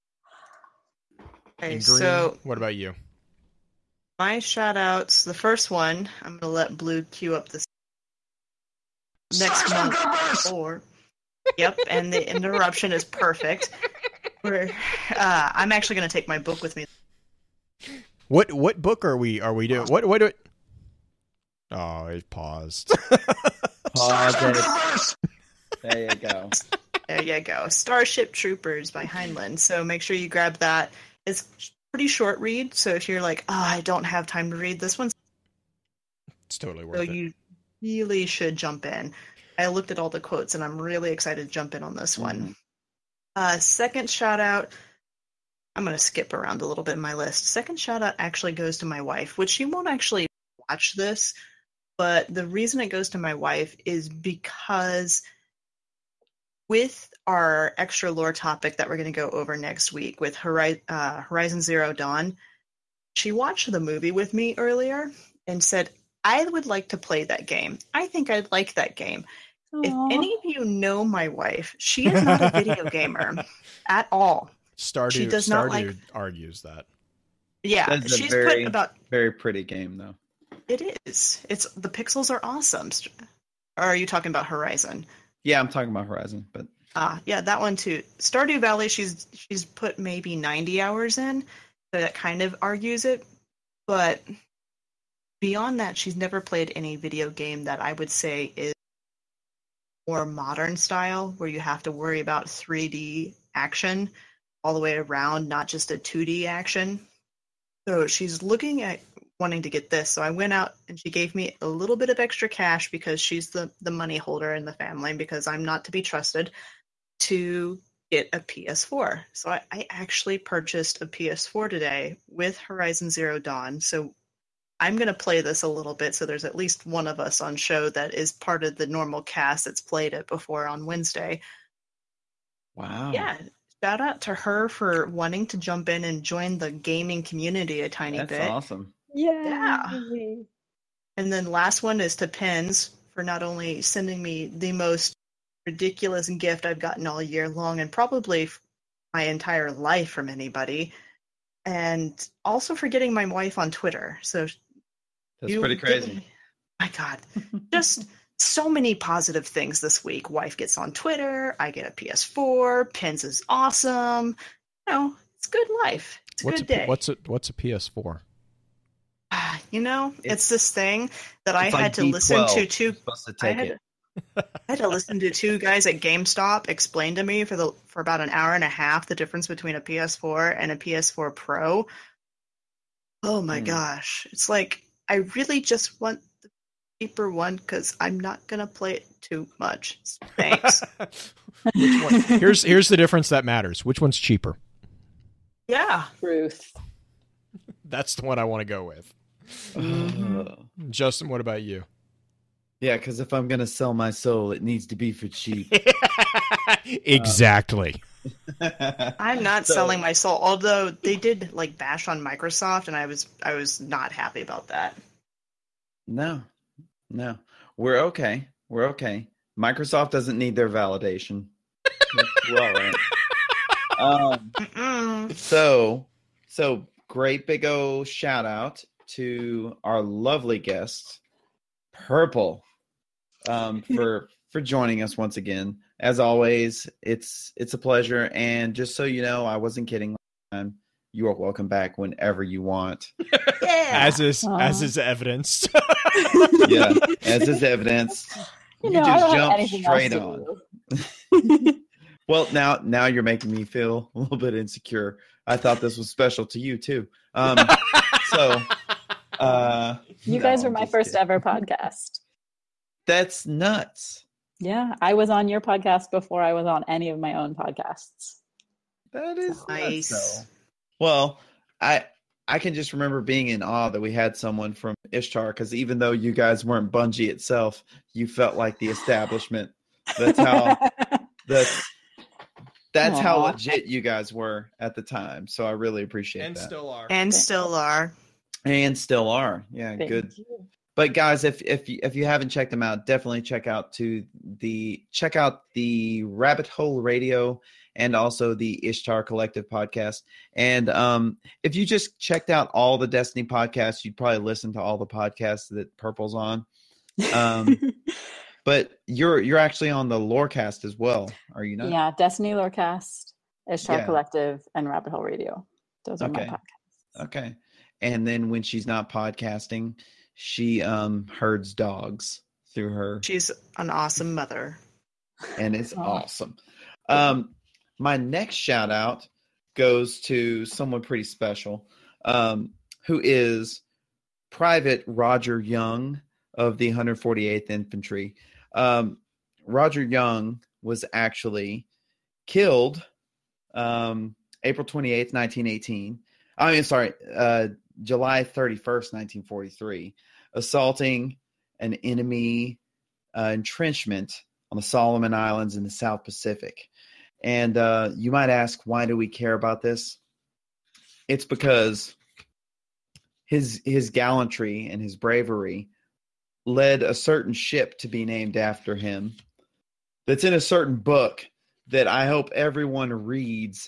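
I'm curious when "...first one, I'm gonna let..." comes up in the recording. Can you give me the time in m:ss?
0:05.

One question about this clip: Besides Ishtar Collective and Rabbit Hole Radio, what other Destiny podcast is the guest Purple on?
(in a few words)
Destiny Lorecast.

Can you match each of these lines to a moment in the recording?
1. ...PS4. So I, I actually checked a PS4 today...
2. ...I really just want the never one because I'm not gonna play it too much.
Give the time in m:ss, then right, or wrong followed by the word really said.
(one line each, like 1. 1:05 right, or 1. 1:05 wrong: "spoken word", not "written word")
1. 1:58 wrong: "purchased", not "checked"
2. 3:05 wrong: "cheaper", not "never".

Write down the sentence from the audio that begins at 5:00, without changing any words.
And um, if you just checked out all the Destiny podcasts, you'd probably listen to all the podcasts that Purple's on.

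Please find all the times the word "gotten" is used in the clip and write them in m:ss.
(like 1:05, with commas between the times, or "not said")
2:26.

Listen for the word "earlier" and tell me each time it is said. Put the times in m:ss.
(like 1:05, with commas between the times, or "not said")
1:04.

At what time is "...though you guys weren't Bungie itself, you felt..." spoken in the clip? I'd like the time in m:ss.
4:36.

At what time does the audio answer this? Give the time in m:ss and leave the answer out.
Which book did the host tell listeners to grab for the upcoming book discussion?
0:27.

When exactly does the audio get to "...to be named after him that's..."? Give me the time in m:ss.
6:07.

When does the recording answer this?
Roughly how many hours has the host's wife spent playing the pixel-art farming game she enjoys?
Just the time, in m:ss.
1:30.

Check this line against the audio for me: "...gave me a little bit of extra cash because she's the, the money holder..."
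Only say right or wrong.
right.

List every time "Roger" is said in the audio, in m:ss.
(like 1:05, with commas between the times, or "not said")
5:35, 5:39.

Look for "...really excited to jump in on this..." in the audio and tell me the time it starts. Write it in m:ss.
0:40.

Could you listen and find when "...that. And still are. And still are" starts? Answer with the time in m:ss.
4:46.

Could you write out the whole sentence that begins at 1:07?
I think I'd like that game.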